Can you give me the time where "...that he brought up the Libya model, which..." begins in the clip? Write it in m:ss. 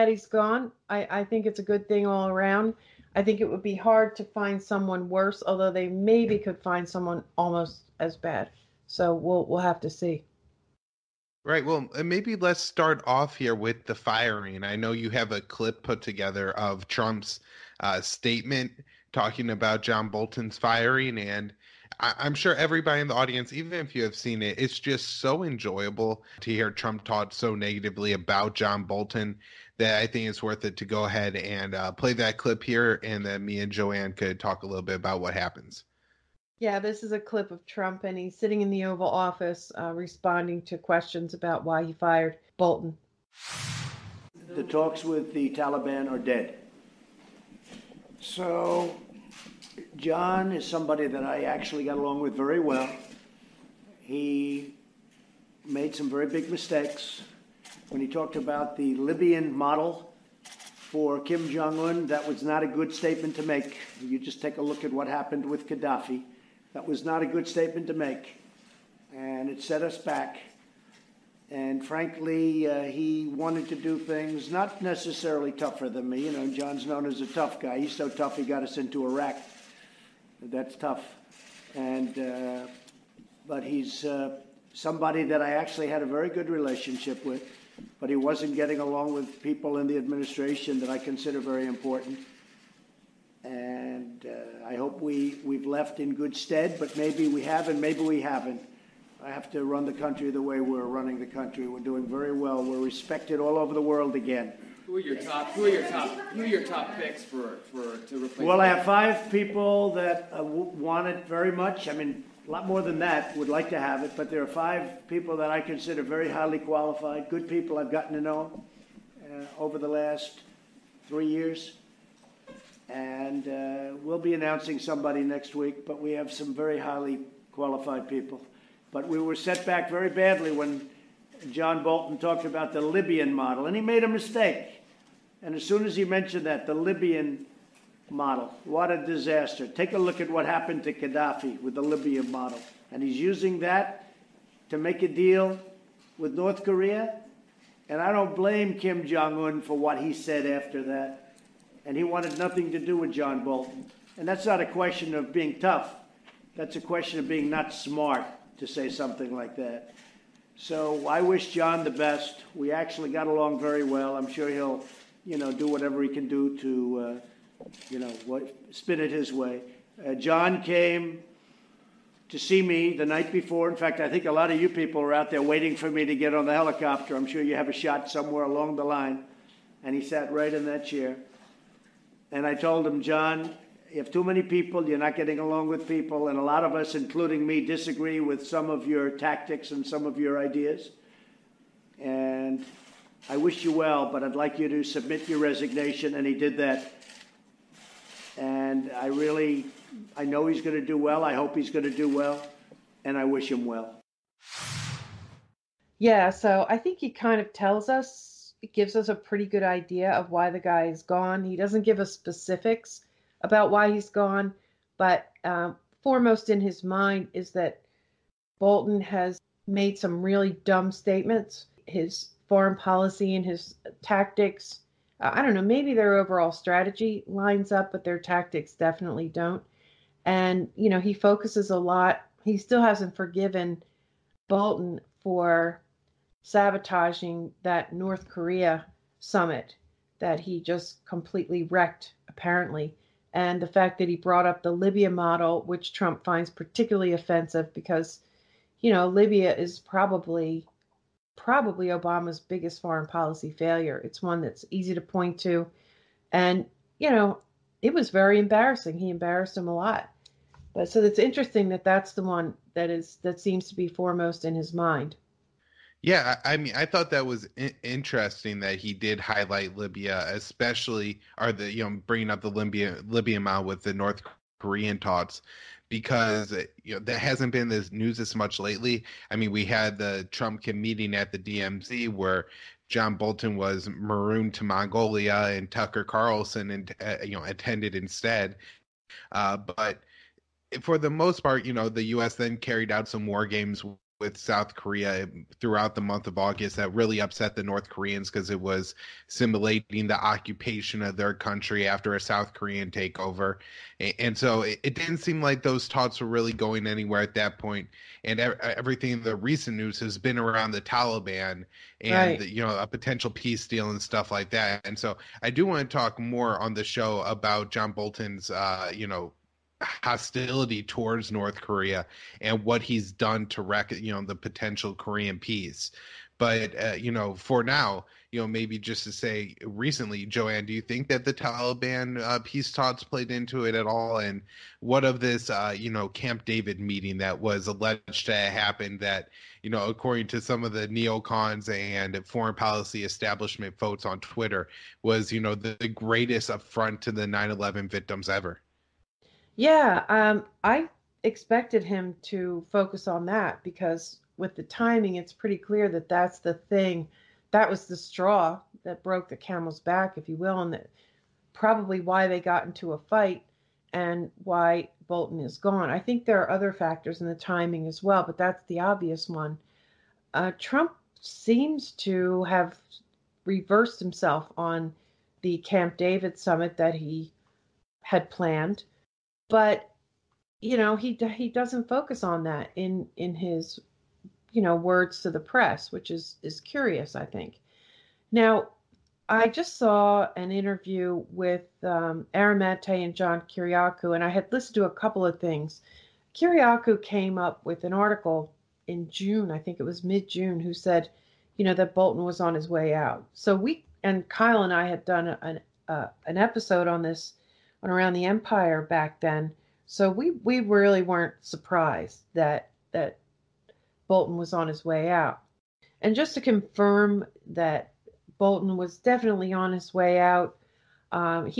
4:03.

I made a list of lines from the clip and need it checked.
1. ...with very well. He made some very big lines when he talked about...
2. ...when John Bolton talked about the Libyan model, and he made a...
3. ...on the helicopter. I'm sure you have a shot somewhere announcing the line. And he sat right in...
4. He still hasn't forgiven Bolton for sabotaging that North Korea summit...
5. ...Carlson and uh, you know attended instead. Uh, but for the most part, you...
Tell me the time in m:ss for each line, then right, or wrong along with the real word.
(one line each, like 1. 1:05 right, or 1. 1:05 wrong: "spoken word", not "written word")
1. 0:52 wrong: "mistakes", not "lines"
2. 2:10 right
3. 2:56 wrong: "along", not "announcing"
4. 3:52 right
5. 4:46 right.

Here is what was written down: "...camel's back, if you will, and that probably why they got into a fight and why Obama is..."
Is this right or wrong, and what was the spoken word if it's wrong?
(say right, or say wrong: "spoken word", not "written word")
wrong: "Bolton", not "Obama".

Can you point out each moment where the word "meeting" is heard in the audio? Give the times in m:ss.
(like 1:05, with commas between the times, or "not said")
4:40, 5:36.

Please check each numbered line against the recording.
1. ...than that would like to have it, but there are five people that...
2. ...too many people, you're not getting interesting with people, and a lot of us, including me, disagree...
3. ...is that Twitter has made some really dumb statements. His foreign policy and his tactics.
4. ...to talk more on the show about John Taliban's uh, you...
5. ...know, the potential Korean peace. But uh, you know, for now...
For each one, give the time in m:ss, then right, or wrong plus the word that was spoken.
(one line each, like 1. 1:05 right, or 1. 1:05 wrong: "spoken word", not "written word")
1. 1:52 right
2. 3:04 wrong: "along", not "interesting"
3. 3:37 wrong: "Bolton", not "Twitter"
4. 5:15 wrong: "Bolton", not "Taliban"
5. 5:24 right.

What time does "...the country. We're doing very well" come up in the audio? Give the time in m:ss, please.
1:41.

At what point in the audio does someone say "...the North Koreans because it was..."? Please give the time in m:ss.
4:57.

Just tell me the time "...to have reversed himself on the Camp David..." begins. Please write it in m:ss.
6:11.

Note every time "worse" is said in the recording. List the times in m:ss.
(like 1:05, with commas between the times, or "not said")
0:05.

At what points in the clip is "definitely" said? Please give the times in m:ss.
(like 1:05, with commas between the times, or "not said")
3:48, 6:58.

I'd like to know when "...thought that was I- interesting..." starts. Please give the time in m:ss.
4:26.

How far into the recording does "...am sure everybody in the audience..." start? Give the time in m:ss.
0:22.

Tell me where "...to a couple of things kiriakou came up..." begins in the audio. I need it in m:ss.
6:34.